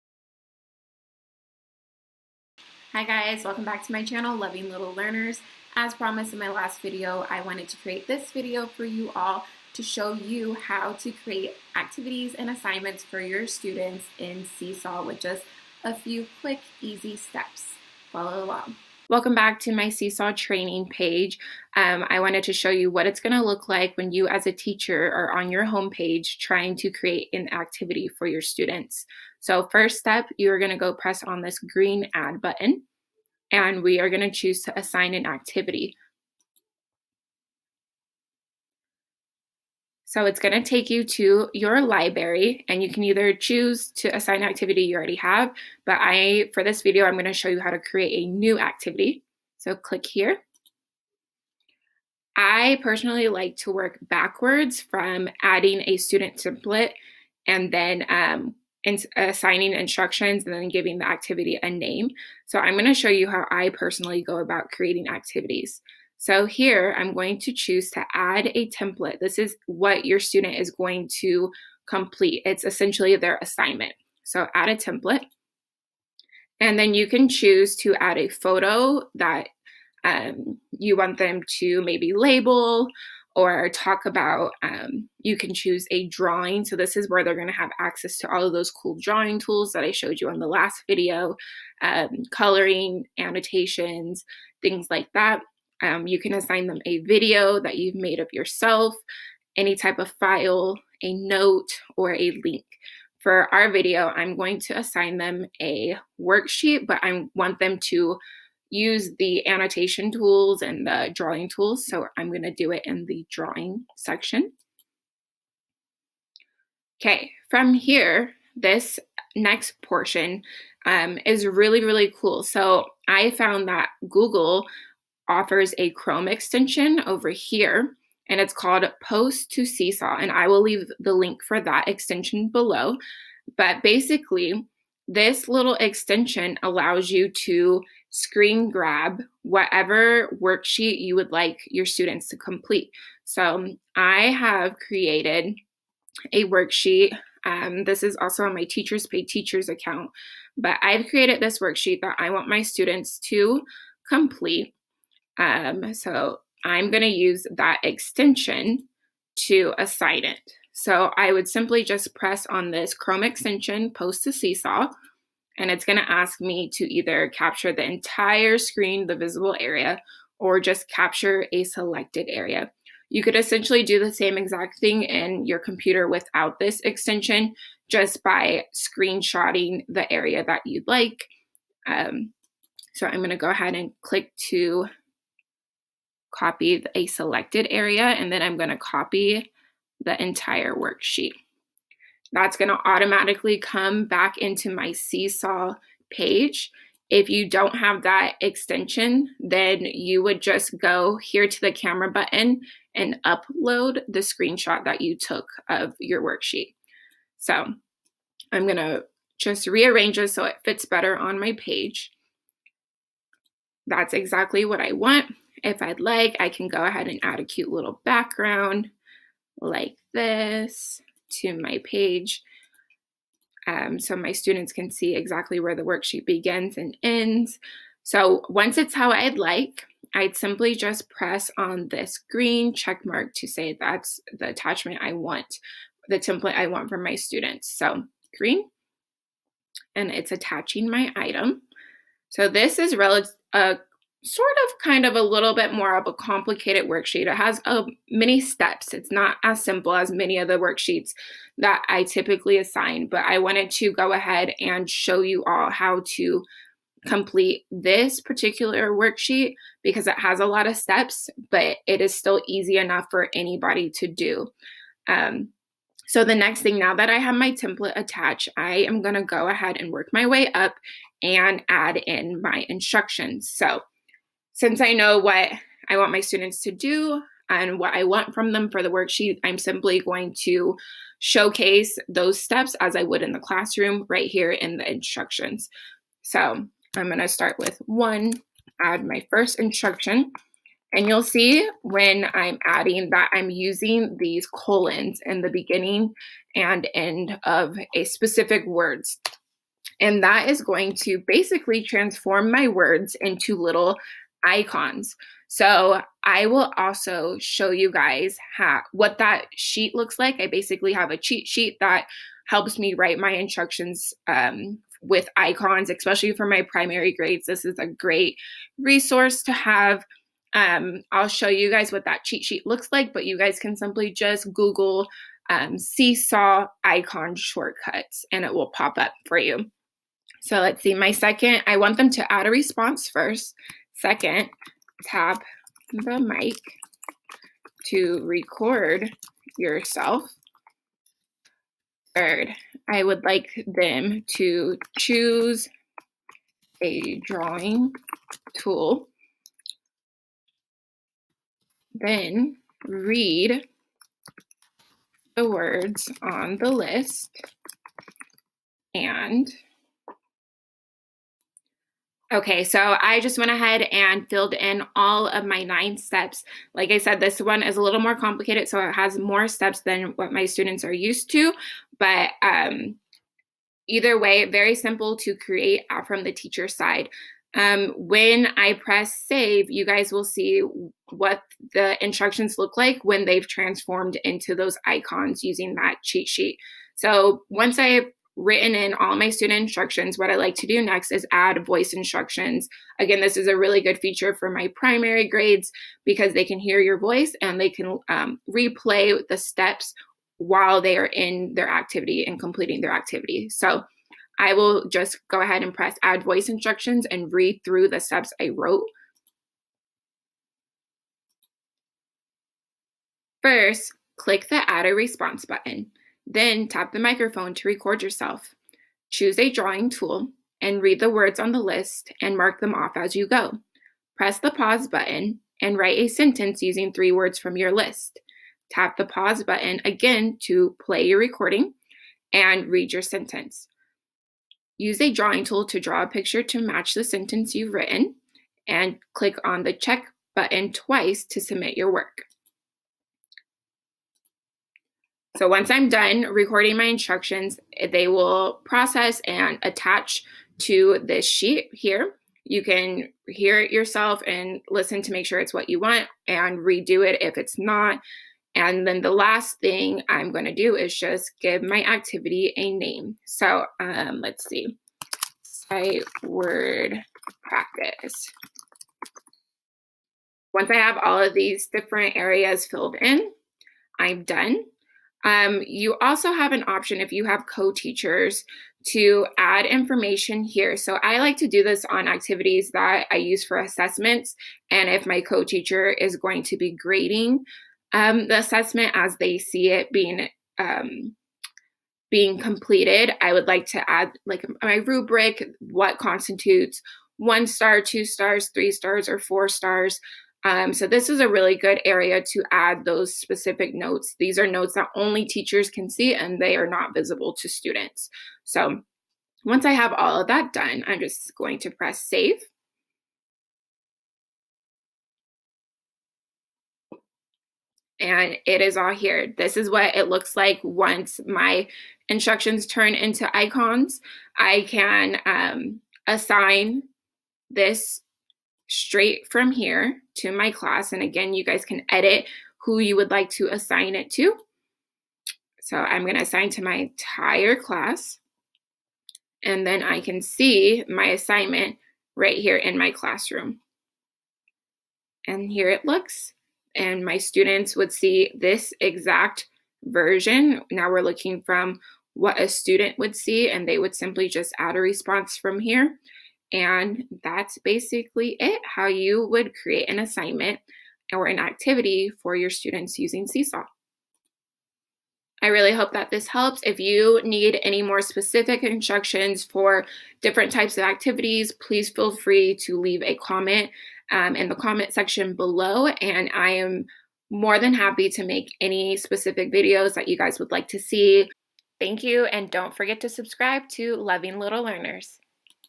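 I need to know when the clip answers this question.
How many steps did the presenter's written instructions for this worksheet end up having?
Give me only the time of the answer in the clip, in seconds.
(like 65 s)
365 s.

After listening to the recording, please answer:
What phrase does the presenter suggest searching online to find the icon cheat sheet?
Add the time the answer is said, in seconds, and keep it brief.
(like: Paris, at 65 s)
seesaw icon shortcuts, at 325 s.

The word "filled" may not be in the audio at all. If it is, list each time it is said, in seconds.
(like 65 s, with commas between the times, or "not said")
364 s, 472 s.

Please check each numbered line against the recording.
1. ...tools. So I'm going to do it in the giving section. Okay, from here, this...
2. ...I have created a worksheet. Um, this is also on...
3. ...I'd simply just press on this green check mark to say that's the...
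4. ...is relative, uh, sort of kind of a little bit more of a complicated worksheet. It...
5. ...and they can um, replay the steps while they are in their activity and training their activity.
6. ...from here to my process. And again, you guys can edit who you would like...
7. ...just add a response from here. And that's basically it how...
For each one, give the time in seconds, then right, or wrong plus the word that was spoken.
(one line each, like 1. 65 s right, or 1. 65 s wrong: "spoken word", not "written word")
1. 111 s wrong: "drawing", not "giving"
2. 143 s right
3. 230 s right
4. 242 s right
5. 397 s wrong: "completing", not "training"
6. 529 s wrong: "class", not "process"
7. 554 s right.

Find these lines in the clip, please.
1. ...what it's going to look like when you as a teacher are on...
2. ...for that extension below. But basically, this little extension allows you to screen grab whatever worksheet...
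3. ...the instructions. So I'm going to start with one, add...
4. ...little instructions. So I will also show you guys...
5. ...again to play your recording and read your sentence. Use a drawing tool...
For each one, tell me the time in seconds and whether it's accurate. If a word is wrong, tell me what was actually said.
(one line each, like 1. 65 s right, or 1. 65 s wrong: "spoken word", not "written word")
1. 22 s right
2. 131 s right
3. 284 s right
4. 303 s wrong: "icons", not "instructions"
5. 429 s right.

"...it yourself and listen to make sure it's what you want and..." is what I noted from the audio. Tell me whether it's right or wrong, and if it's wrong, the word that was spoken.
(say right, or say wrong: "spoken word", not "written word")
right.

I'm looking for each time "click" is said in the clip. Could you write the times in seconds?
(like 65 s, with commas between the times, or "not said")
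49 s, 184 s, 414 s, 439 s.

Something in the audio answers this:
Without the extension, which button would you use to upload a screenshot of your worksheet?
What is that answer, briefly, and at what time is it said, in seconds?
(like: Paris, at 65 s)
camera button, at 201 s.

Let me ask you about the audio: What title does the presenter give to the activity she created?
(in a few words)
Sight word practice.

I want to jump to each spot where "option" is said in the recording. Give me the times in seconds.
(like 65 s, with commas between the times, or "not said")
476 s.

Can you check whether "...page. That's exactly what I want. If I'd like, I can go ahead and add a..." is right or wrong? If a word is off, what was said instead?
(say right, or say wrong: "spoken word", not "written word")
right.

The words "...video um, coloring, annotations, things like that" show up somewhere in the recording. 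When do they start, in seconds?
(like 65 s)
90 s.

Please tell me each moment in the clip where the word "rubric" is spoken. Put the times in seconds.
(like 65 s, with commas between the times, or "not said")
494 s.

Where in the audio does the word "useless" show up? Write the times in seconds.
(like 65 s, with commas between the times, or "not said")
not said.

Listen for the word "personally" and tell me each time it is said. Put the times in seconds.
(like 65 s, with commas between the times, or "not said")
52 s, 63 s.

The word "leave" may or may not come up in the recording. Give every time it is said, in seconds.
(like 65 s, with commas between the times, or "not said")
130 s, 572 s.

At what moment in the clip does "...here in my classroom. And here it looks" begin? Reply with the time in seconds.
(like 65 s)
542 s.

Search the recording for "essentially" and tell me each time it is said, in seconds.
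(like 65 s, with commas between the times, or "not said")
72 s, 173 s.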